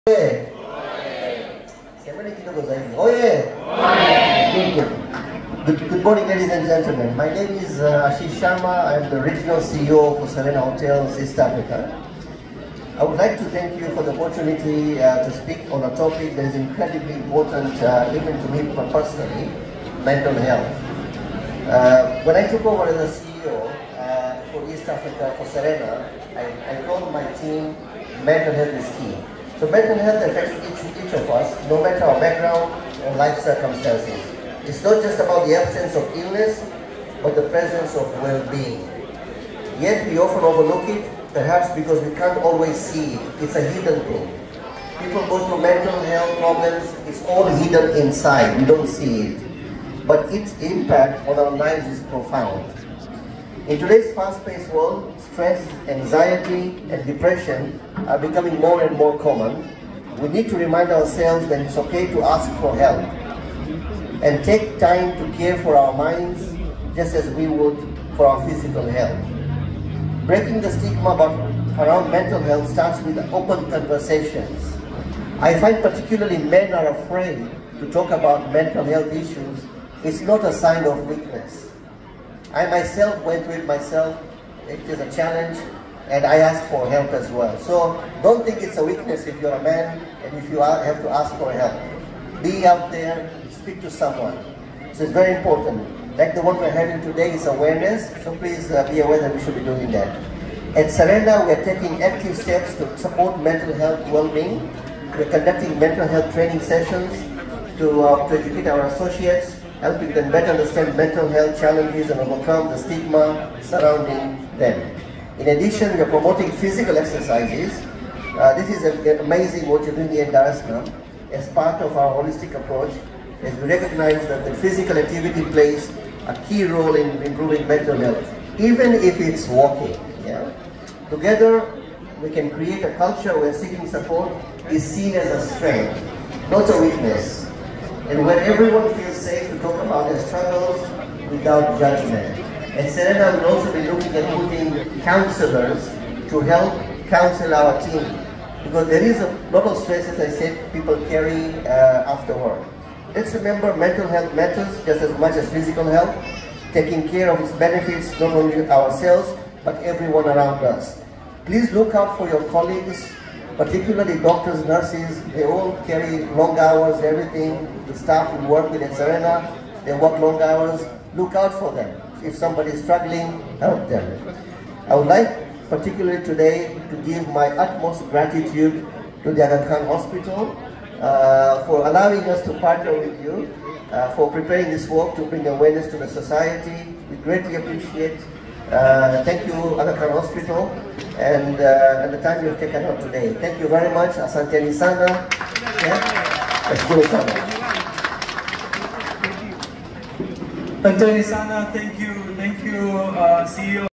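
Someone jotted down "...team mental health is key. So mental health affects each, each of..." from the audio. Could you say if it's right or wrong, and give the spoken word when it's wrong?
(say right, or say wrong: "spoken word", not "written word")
right.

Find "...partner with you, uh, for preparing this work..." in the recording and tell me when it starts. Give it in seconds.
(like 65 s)
182 s.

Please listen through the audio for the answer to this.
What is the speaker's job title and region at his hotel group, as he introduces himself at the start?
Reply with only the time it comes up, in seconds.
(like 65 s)
9 s.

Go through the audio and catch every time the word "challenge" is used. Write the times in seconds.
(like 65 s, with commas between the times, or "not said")
85 s, 111 s.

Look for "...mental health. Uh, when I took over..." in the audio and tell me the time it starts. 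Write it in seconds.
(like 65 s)
20 s.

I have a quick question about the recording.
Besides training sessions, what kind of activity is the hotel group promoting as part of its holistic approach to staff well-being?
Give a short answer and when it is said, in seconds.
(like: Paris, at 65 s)
Physical exercises, at 116 s.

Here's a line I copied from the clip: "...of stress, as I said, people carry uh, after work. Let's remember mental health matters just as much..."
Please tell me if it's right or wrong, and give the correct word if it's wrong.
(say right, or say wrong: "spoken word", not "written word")
right.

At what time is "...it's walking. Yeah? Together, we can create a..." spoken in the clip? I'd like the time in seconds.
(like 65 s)
129 s.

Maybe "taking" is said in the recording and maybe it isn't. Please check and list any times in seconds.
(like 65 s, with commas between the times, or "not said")
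101 s, 156 s.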